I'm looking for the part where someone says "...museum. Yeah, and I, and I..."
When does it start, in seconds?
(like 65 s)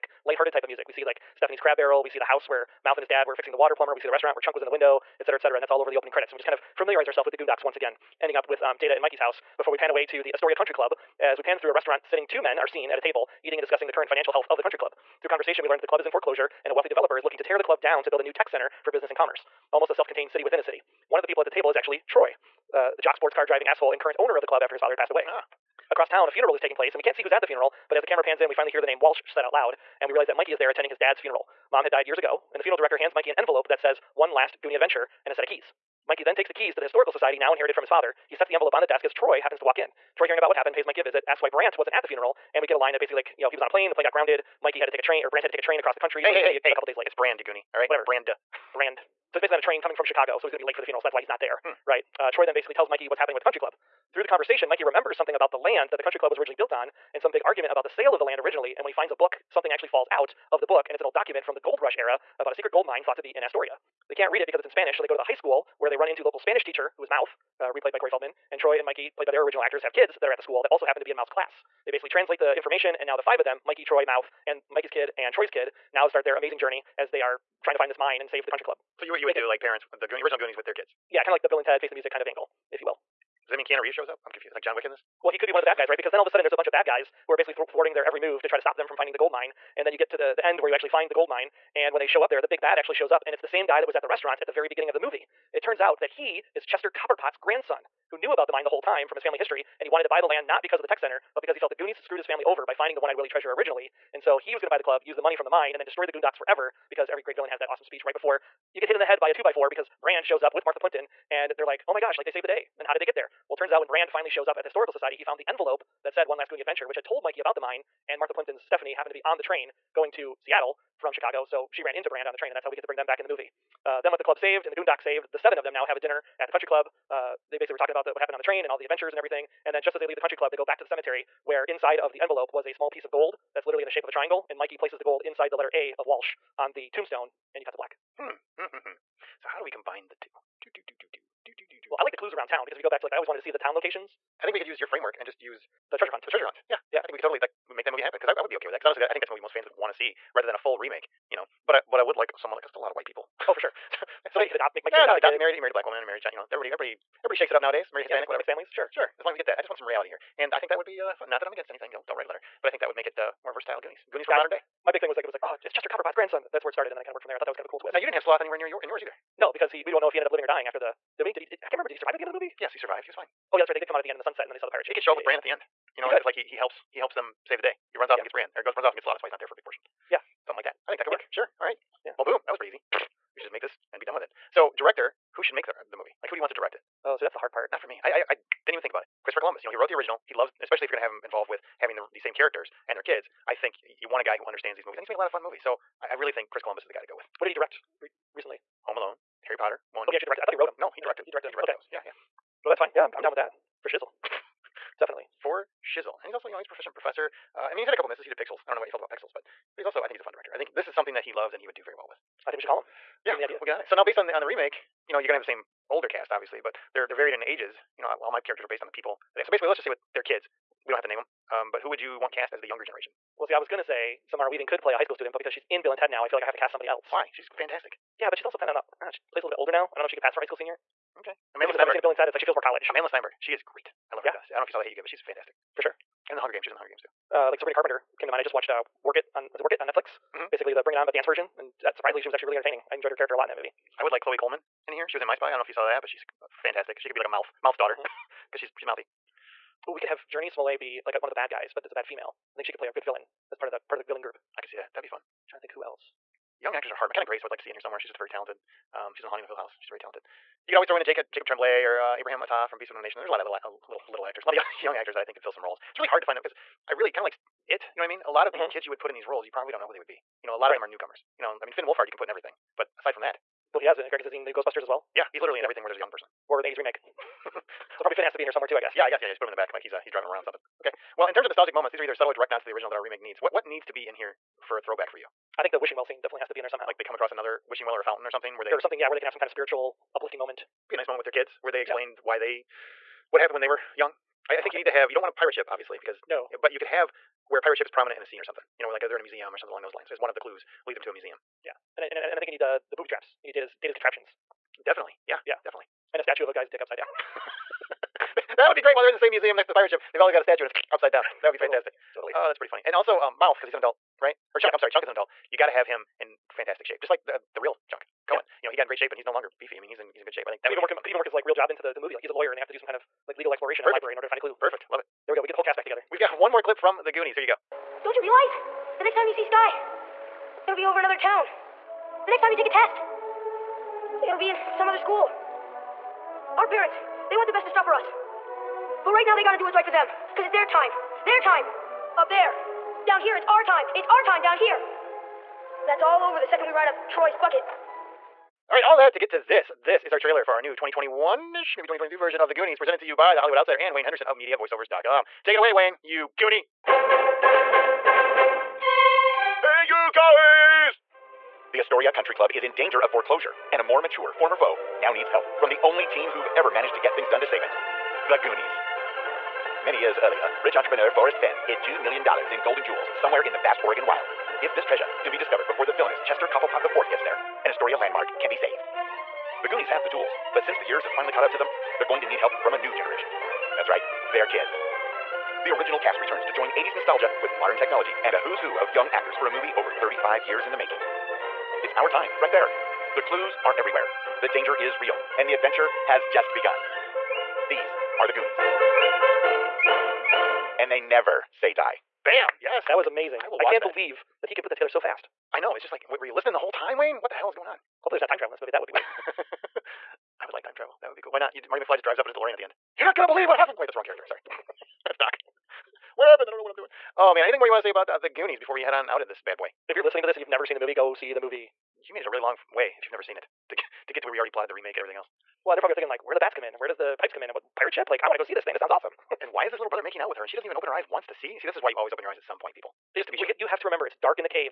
301 s.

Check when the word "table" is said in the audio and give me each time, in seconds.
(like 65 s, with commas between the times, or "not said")
12 s, 21 s.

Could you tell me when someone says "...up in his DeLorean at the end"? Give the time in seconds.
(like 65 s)
412 s.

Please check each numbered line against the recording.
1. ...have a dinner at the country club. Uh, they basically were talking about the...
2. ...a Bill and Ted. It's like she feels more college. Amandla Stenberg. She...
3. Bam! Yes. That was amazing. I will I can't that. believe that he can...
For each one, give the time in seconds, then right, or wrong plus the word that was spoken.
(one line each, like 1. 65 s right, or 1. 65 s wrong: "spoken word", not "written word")
1. 125 s right
2. 231 s right
3. 402 s right.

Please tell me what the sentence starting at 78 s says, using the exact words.
So you you would do like parents the Goonies, original Goonies with their kids.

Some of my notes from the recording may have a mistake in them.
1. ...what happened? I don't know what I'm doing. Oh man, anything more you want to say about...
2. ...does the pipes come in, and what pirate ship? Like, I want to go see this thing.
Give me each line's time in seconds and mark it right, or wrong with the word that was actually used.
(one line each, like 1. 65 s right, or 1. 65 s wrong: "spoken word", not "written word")
1. 416 s right
2. 426 s right.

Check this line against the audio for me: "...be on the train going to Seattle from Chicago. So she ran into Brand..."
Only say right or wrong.
right.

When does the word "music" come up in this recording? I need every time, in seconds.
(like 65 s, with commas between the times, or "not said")
0 s, 81 s.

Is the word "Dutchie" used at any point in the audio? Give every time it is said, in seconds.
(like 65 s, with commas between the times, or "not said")
not said.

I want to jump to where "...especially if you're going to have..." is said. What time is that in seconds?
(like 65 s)
190 s.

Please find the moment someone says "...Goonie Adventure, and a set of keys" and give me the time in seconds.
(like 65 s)
34 s.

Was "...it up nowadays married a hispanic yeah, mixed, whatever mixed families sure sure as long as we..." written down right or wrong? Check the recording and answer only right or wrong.
right.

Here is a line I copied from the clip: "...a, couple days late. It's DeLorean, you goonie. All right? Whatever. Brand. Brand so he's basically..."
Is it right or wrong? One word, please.
wrong.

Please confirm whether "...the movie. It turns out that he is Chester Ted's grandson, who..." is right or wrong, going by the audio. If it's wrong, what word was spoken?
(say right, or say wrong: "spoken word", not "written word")
wrong: "Copperpot", not "Ted".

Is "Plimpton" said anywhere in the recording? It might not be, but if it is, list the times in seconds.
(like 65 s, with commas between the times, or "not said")
110 s, 118 s.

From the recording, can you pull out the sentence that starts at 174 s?
He can show up yeah, with yeah, Bran yeah.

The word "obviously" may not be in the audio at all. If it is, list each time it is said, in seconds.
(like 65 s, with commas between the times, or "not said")
216 s, 295 s.